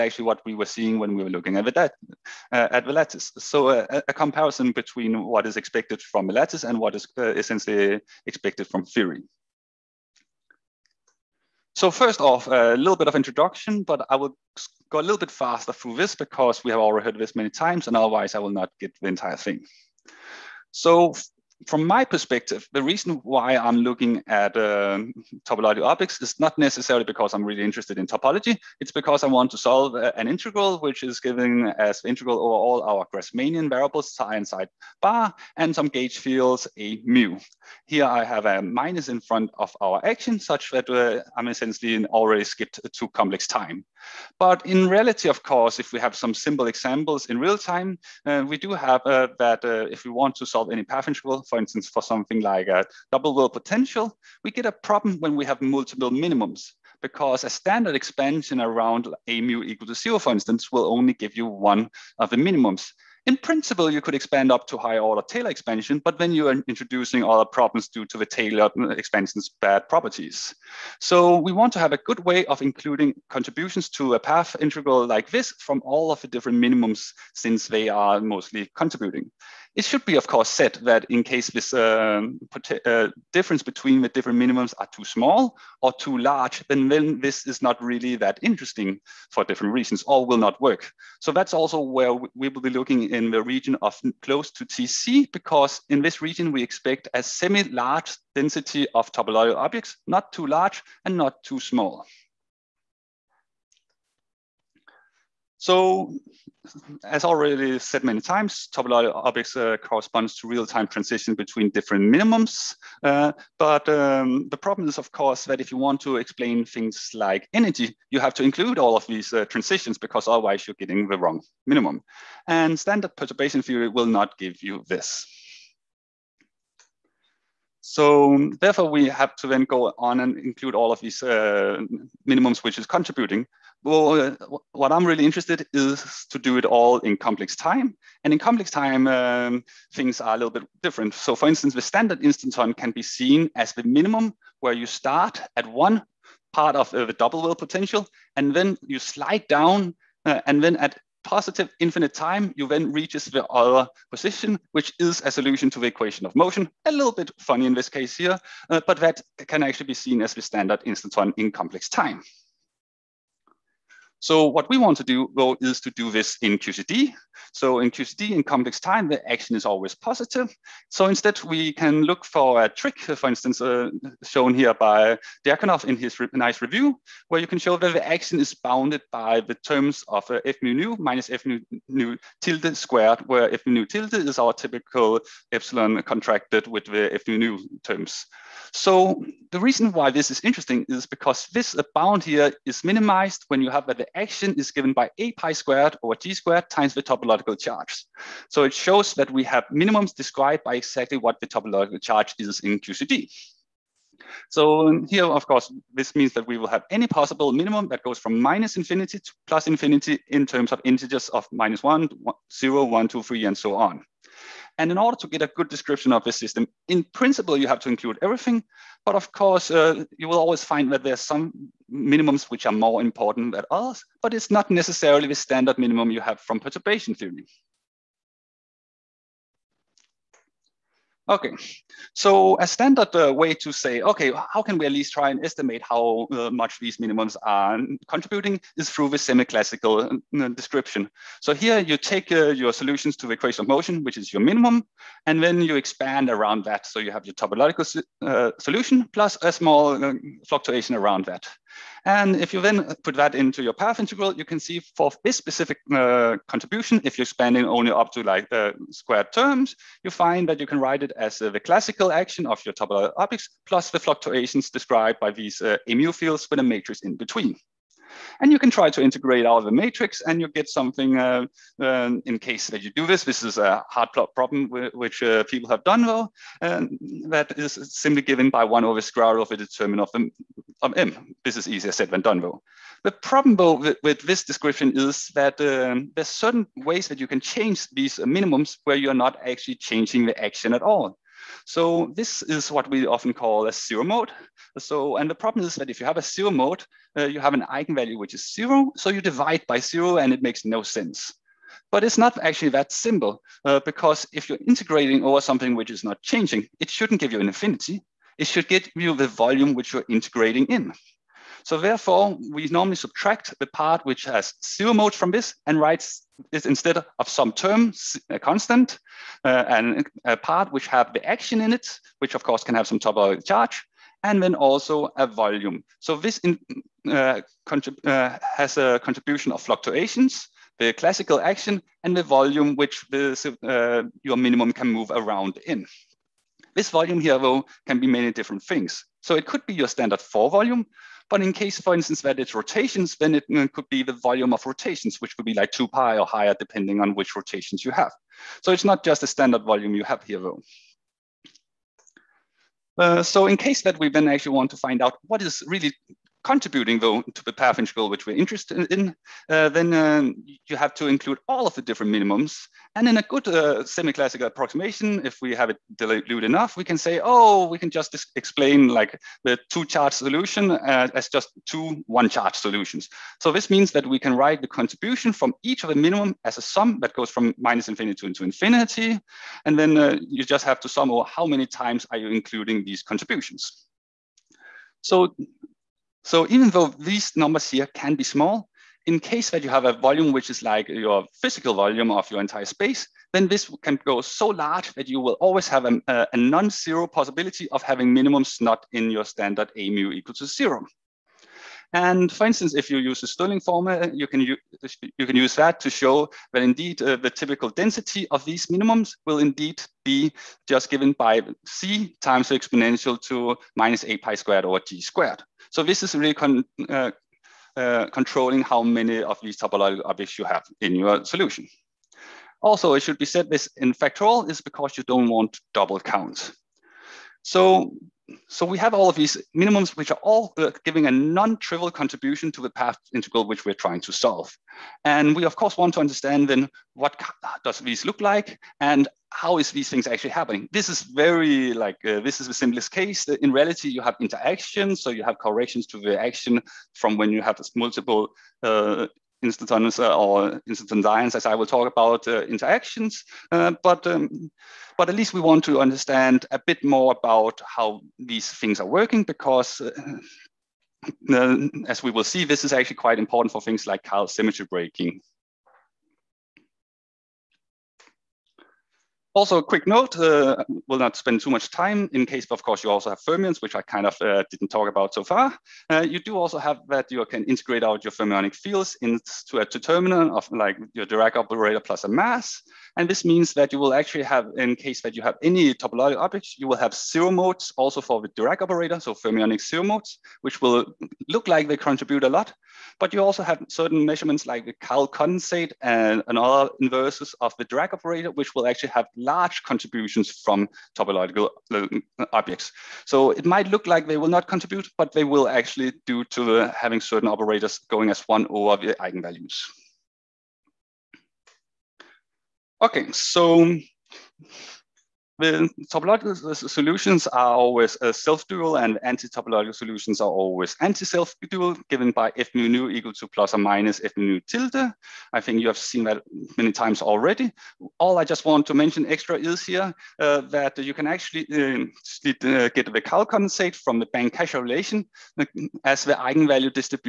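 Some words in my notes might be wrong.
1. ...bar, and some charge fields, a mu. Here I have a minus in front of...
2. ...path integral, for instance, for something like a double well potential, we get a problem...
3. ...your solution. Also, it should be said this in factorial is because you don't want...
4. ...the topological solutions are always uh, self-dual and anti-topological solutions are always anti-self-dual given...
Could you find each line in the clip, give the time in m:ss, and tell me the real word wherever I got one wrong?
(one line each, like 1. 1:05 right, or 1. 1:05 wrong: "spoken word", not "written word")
1. 0:35 wrong: "gauge", not "charge"
2. 0:50 right
3. 7:00 right
4. 8:35 right.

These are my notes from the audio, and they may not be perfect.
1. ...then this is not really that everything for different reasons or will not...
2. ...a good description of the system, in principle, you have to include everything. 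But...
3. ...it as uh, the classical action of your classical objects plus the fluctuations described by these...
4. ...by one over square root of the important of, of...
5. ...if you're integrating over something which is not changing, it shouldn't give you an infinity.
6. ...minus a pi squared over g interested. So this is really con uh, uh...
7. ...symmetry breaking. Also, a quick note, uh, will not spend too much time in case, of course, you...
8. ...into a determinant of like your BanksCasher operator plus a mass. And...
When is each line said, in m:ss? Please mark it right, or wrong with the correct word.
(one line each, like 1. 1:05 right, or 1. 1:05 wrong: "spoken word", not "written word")
1. 1:26 wrong: "interesting", not "everything"
2. 3:35 right
3. 4:21 wrong: "topological", not "classical"
4. 4:38 wrong: "determinant", not "important"
5. 5:04 right
6. 6:54 wrong: "squared", not "interested"
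7. 7:44 right
8. 7:59 wrong: "Dirac", not "BanksCasher".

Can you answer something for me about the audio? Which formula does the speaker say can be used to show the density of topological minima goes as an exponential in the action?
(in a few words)
Stirling formula.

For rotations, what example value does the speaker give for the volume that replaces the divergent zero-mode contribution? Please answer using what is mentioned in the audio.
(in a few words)
2 pi.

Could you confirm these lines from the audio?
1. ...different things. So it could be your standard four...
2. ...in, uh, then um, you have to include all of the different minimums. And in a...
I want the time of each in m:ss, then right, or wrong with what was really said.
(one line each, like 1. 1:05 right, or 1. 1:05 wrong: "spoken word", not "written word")
1. 5:38 right
2. 5:58 right.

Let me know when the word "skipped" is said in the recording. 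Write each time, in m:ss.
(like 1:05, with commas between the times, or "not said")
0:42.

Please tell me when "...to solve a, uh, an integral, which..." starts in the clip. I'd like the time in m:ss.
0:29.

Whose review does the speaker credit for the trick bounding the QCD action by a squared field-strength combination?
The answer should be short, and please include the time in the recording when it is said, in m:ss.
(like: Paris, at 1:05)
Diakonov, at 2:55.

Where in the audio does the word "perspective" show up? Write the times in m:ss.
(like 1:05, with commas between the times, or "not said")
0:22.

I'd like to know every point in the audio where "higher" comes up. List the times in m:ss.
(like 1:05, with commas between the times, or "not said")
1:04, 5:46.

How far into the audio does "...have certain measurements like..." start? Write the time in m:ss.
8:13.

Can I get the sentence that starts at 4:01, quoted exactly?
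So here you take uh, your solutions to the equation of motion, which is your minimum, and then you expand around that.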